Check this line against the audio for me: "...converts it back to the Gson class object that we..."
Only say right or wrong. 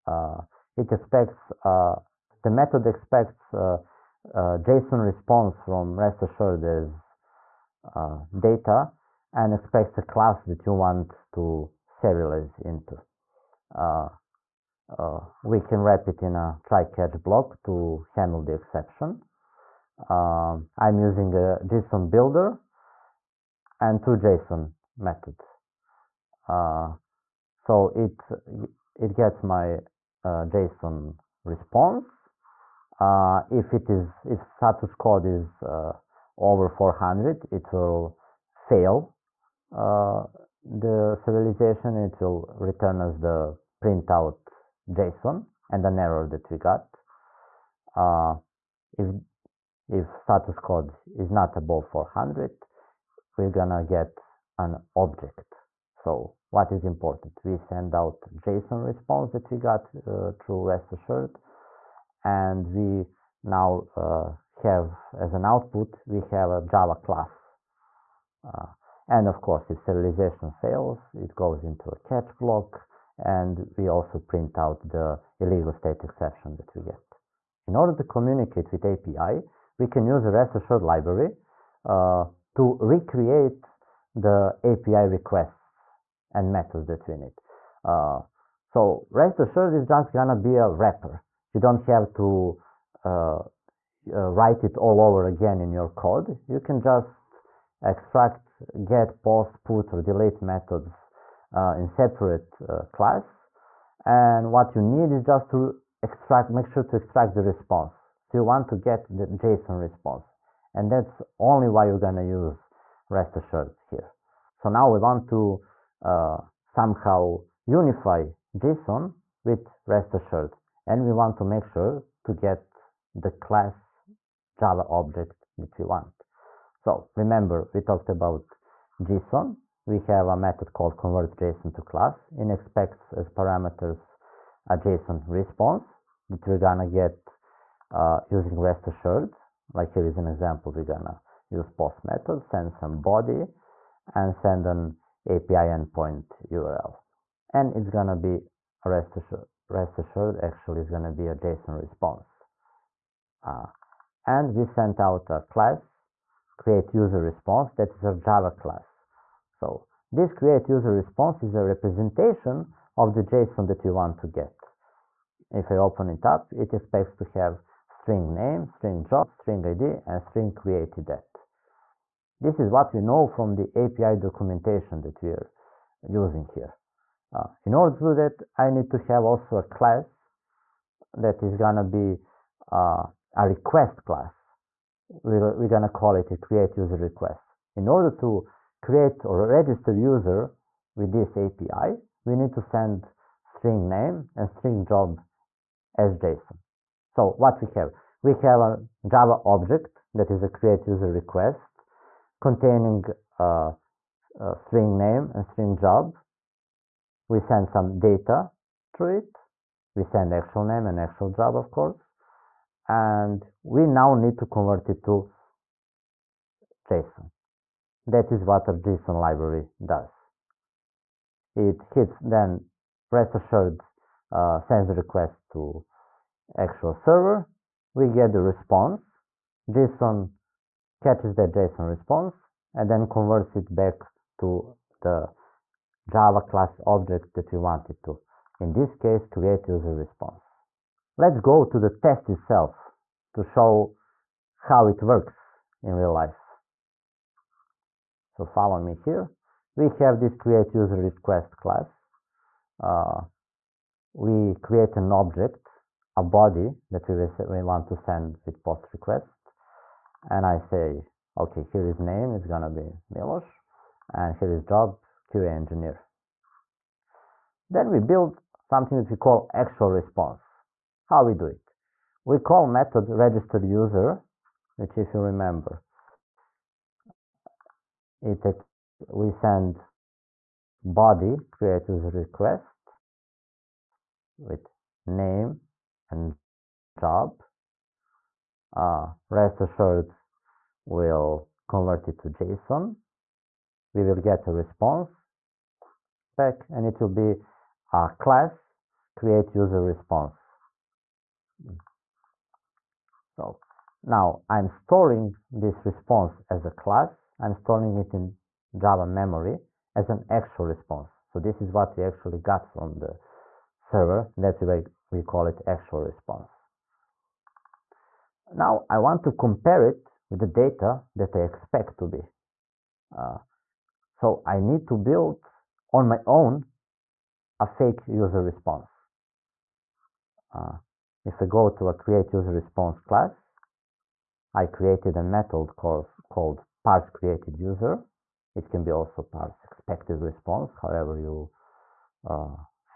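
wrong.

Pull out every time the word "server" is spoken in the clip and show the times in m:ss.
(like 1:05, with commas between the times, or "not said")
3:46, 5:13.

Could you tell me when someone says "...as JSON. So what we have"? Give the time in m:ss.
3:15.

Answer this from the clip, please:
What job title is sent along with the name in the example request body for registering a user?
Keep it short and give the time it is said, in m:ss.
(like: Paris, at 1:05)
QA engineer, at 4:25.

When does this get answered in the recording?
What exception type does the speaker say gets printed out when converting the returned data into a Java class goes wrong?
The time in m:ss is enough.
1:15.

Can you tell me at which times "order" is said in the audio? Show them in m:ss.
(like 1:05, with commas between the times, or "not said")
1:17, 2:57, 3:07.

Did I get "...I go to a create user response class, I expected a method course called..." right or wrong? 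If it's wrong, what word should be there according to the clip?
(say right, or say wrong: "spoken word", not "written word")
wrong: "created", not "expected".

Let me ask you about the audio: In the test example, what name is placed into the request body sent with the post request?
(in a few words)
Milos.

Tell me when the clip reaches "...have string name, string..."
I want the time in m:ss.
2:47.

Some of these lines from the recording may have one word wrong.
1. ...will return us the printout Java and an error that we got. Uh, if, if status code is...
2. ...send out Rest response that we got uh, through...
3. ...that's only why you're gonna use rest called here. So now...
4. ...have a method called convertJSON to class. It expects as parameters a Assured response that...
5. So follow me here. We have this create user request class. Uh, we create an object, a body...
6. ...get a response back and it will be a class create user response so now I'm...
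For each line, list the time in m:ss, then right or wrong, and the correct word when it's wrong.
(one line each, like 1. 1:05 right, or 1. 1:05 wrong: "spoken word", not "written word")
1. 0:42 wrong: "JSON", not "Java"
2. 0:57 wrong: "JSON", not "Rest"
3. 1:50 wrong: "assured", not "called"
4. 2:09 wrong: "JSON", not "Assured"
5. 4:08 right
6. 4:54 right.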